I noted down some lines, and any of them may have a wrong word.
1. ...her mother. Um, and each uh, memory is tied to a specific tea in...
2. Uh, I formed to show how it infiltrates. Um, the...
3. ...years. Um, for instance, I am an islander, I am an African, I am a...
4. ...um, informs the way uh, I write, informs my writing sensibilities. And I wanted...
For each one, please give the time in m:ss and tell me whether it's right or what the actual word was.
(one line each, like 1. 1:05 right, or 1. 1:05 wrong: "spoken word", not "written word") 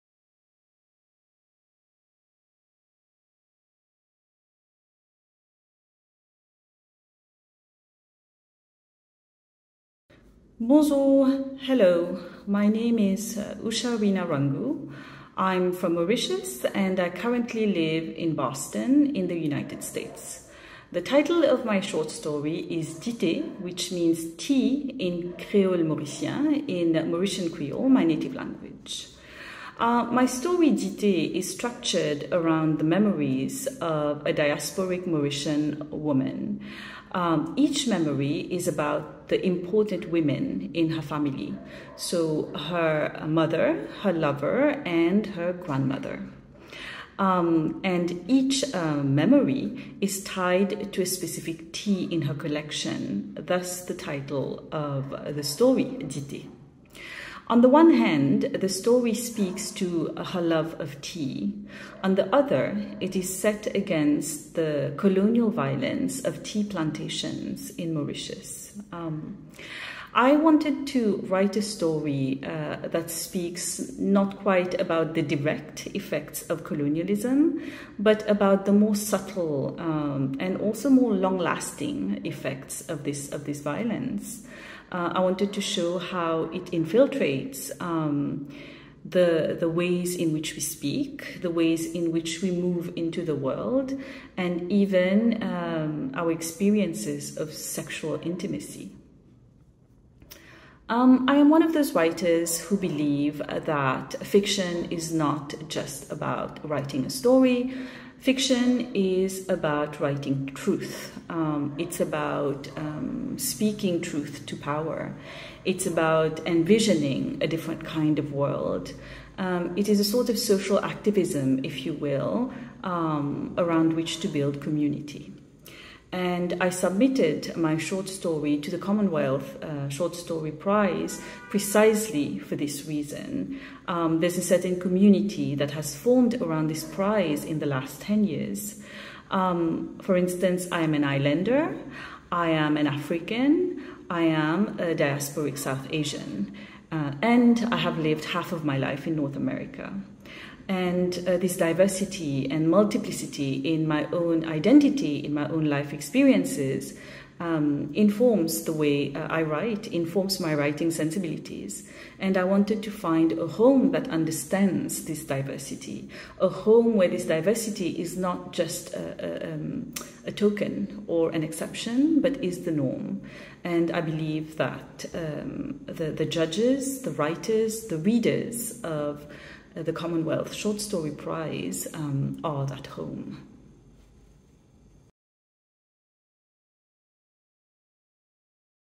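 1. 0:45 wrong: "grandmother", not "mother"
2. 1:24 wrong: "wanted", not "formed"
3. 2:18 right
4. 2:37 right.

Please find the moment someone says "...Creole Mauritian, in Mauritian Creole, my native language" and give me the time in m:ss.
0:25.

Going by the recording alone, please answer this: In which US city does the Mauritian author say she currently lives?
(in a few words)
Boston.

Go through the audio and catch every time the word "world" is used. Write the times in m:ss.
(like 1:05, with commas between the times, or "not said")
1:33, 1:58.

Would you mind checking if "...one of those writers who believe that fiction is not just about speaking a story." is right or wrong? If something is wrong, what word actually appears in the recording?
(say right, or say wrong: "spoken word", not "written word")
wrong: "writing", not "speaking".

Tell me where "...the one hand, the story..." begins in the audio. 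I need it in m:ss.
0:57.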